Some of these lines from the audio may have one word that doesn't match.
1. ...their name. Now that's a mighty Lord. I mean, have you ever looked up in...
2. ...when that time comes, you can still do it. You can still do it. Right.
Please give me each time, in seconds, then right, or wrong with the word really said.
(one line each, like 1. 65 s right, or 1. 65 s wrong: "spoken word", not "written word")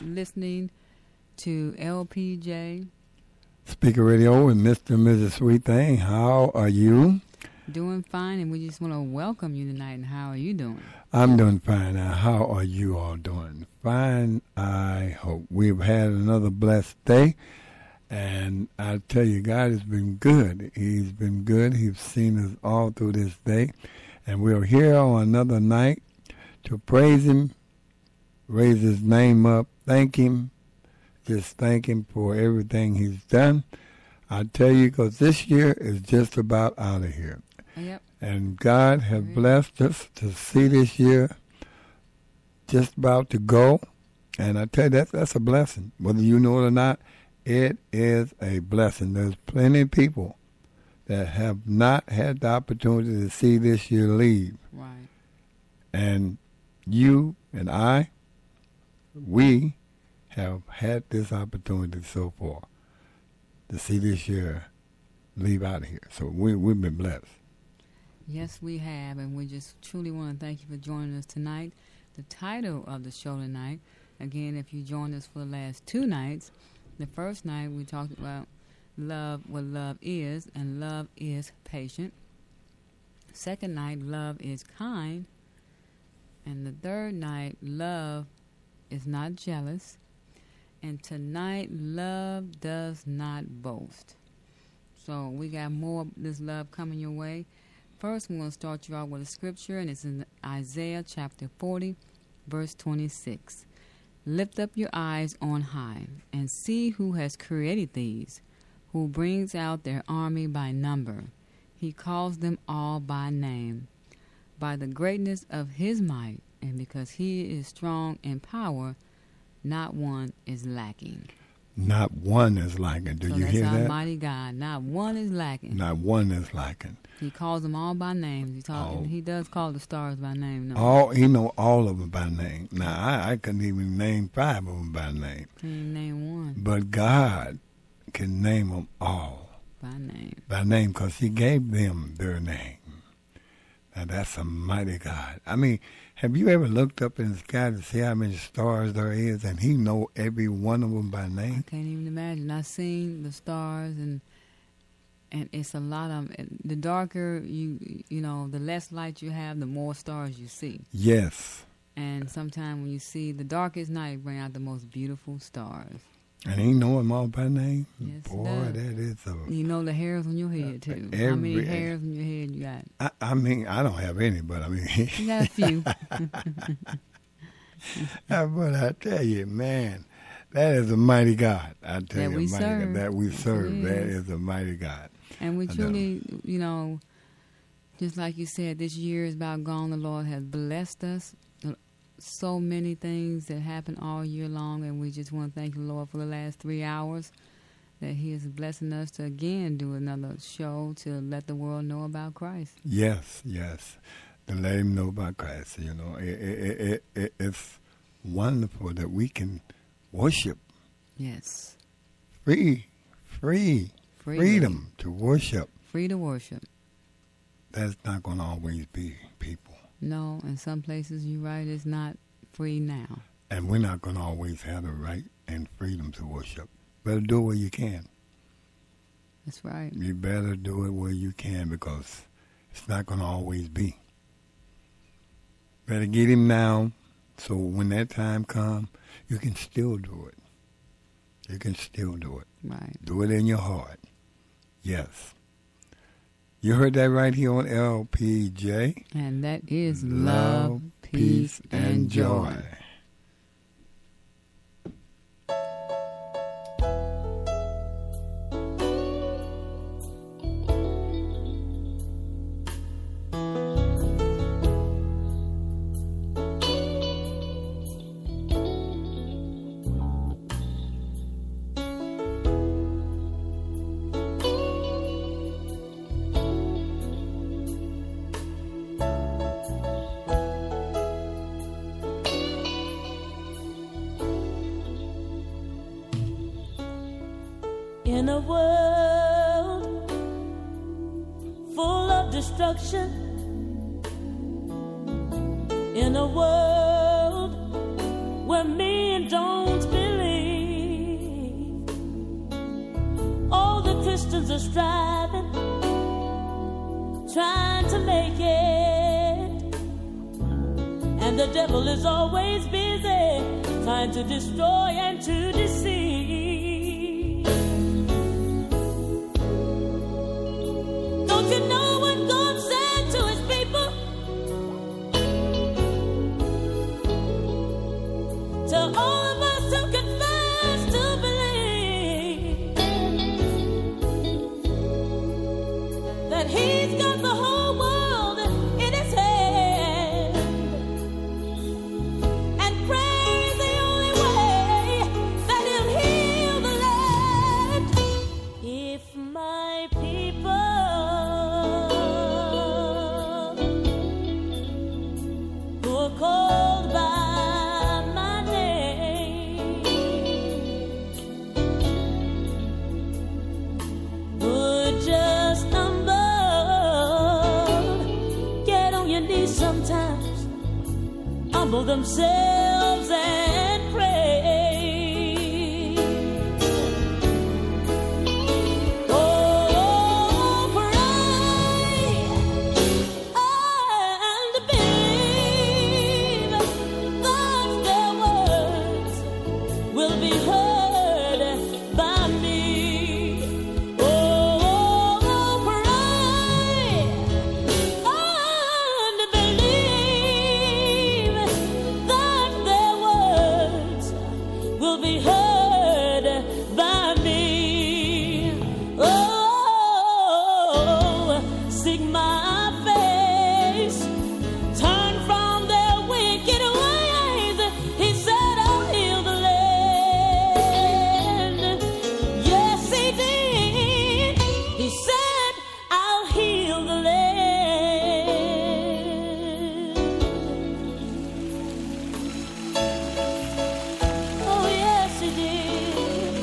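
1. 142 s wrong: "God", not "Lord"
2. 237 s right.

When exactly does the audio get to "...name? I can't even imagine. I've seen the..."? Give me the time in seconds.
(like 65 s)
151 s.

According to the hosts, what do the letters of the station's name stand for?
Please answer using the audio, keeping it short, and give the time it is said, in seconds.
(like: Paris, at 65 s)
Love, peace, and joy, at 250 s.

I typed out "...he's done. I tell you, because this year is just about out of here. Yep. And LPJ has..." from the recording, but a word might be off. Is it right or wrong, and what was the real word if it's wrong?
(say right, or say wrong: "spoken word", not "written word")
wrong: "God", not "LPJ".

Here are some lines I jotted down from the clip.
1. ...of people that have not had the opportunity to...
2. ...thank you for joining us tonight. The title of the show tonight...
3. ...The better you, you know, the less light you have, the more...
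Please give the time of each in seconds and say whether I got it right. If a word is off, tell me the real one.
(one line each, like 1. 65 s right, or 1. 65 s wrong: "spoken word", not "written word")
1. 49 s right
2. 70 s right
3. 156 s wrong: "darker", not "better".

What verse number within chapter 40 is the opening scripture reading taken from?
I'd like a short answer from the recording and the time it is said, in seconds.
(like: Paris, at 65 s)
26, at 102 s.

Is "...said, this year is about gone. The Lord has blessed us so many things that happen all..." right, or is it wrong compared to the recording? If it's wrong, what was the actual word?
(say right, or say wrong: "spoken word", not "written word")
right.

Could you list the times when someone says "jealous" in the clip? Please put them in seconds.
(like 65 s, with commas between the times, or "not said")
89 s.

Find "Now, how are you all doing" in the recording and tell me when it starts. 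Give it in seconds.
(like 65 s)
11 s.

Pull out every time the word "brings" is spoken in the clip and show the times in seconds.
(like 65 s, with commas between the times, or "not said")
109 s, 164 s.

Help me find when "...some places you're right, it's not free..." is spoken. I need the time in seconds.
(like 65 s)
220 s.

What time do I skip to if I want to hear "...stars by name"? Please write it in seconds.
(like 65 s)
129 s.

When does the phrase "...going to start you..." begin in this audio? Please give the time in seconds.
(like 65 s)
98 s.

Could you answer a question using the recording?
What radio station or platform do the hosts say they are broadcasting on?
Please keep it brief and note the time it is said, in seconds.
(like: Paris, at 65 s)
LPJ Spreaker Radio, at 1 s.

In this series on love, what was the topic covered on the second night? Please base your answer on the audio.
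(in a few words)
Love is kind.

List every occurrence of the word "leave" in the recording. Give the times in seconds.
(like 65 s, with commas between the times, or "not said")
54 s, 65 s.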